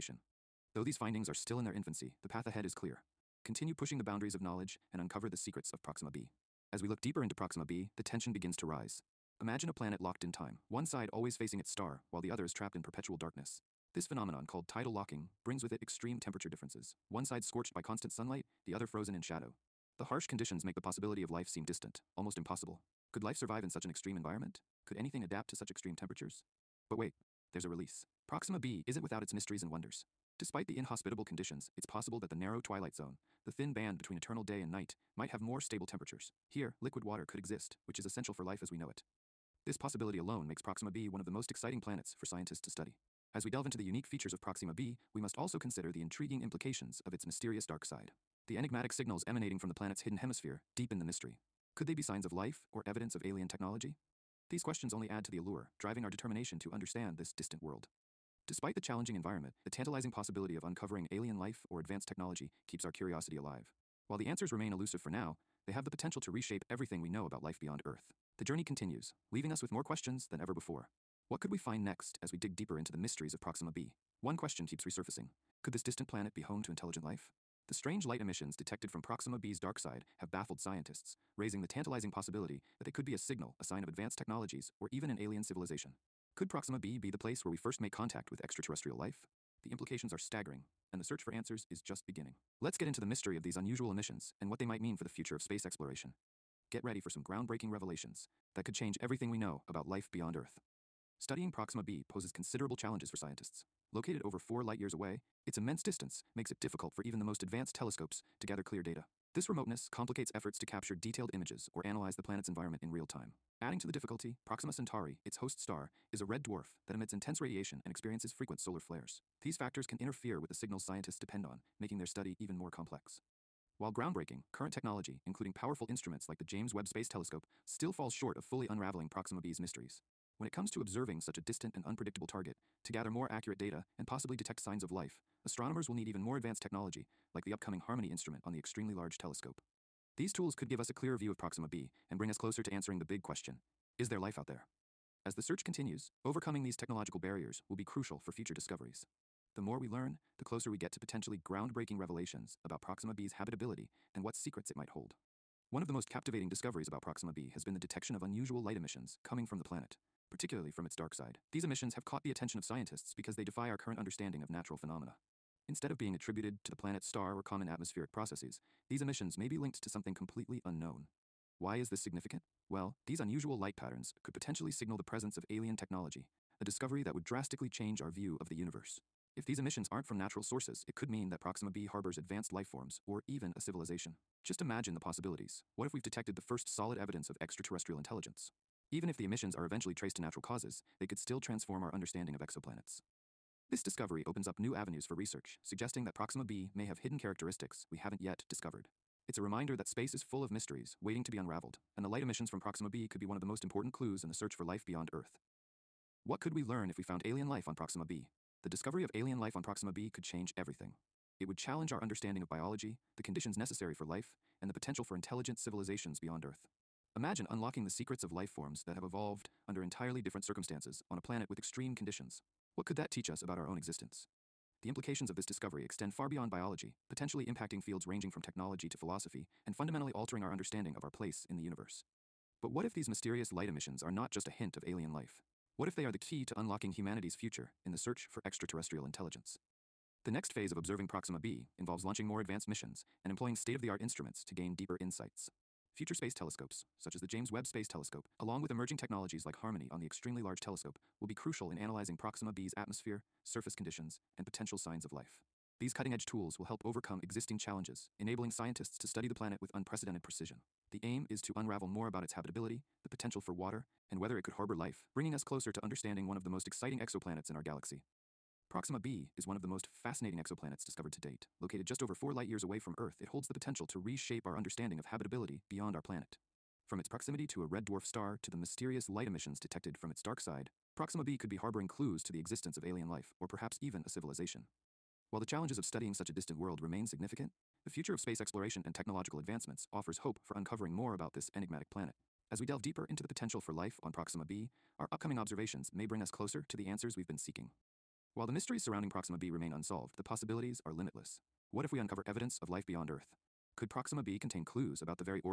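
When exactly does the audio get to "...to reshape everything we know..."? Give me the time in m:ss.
1:06.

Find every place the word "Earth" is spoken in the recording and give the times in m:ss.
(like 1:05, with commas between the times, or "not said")
1:07, 1:40, 3:25, 3:36, 4:32, 5:03.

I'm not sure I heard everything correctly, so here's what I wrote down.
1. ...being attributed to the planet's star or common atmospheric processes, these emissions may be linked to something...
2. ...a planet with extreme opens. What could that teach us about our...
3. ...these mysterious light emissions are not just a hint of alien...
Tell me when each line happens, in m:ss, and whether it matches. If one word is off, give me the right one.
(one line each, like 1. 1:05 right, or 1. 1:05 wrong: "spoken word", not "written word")
1. 2:45 right
2. 3:41 wrong: "conditions", not "opens"
3. 3:52 right.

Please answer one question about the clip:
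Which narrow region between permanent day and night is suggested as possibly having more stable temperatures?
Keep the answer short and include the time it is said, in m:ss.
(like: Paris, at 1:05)
Twilight zone, at 0:32.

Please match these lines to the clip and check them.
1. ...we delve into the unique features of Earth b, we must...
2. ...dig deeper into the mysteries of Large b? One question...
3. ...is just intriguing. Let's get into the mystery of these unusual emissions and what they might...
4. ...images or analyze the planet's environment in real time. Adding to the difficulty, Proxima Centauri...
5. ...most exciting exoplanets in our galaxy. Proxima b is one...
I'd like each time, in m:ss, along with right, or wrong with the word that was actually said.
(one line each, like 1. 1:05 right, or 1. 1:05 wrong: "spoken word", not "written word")
1. 0:43 wrong: "Proxima", not "Earth"
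2. 1:12 wrong: "Proxima", not "Large"
3. 1:31 wrong: "beginning", not "intriguing"
4. 1:51 right
5. 4:26 right.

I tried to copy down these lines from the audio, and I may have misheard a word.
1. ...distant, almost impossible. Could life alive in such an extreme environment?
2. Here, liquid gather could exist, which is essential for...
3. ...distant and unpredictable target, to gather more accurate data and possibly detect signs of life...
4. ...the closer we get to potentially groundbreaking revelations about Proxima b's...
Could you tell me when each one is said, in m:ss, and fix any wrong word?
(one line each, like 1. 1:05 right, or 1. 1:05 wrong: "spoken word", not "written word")
1. 0:21 wrong: "survive", not "alive"
2. 0:36 wrong: "water", not "gather"
3. 2:11 right
4. 2:30 right.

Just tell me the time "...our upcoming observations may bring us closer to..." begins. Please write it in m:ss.
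4:54.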